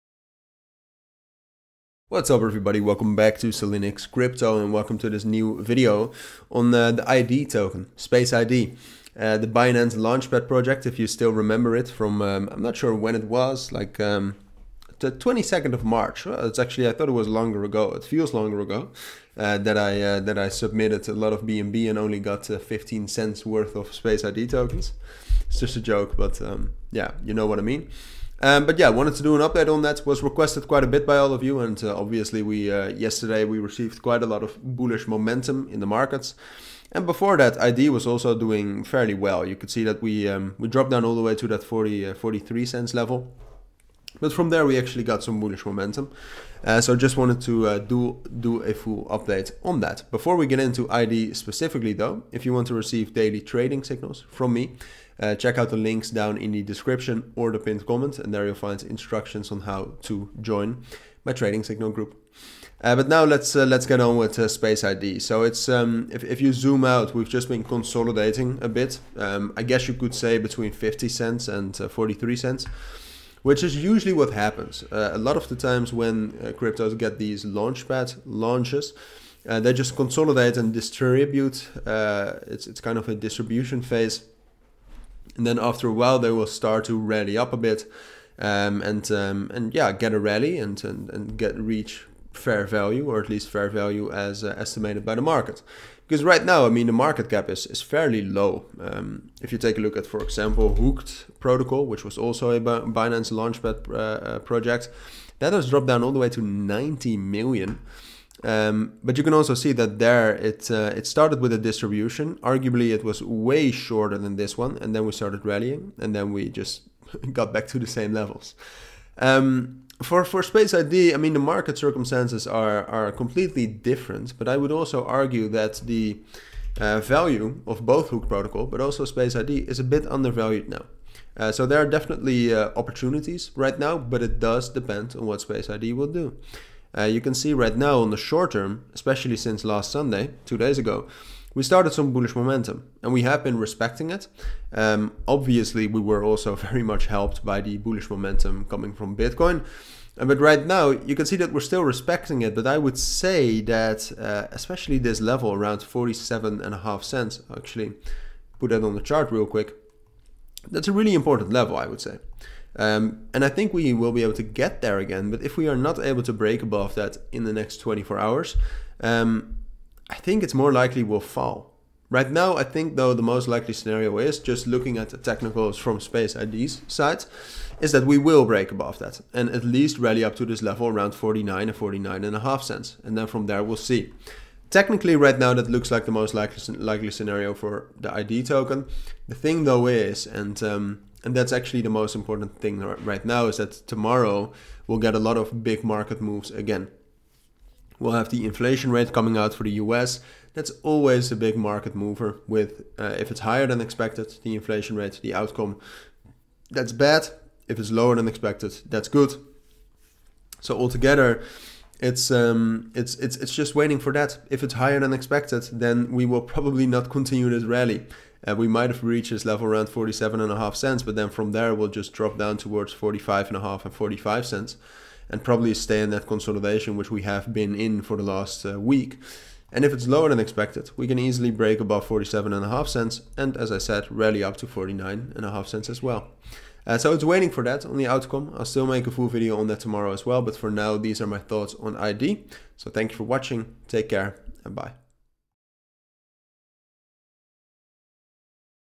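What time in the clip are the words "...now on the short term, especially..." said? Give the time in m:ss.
2:17.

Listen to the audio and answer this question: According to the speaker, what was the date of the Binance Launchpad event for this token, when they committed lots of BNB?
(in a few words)
22nd of March.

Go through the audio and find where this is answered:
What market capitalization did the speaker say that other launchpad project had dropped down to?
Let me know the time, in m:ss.
1:46.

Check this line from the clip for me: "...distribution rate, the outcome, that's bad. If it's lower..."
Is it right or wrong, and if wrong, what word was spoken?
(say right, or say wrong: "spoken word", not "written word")
wrong: "inflation", not "distribution".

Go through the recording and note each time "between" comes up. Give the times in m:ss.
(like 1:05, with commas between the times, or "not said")
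1:10.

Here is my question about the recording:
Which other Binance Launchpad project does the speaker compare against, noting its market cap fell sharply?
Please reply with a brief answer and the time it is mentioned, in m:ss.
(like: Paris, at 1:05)
Hooked Protocol, at 1:40.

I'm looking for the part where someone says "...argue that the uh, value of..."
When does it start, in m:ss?
2:05.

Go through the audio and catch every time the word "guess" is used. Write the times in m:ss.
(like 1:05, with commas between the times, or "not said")
1:09.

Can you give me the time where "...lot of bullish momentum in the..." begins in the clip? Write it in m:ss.
0:34.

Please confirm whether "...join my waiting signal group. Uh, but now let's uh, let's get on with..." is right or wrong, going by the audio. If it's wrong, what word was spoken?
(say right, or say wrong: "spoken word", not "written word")
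wrong: "trading", not "waiting".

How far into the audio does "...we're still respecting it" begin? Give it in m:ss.
2:31.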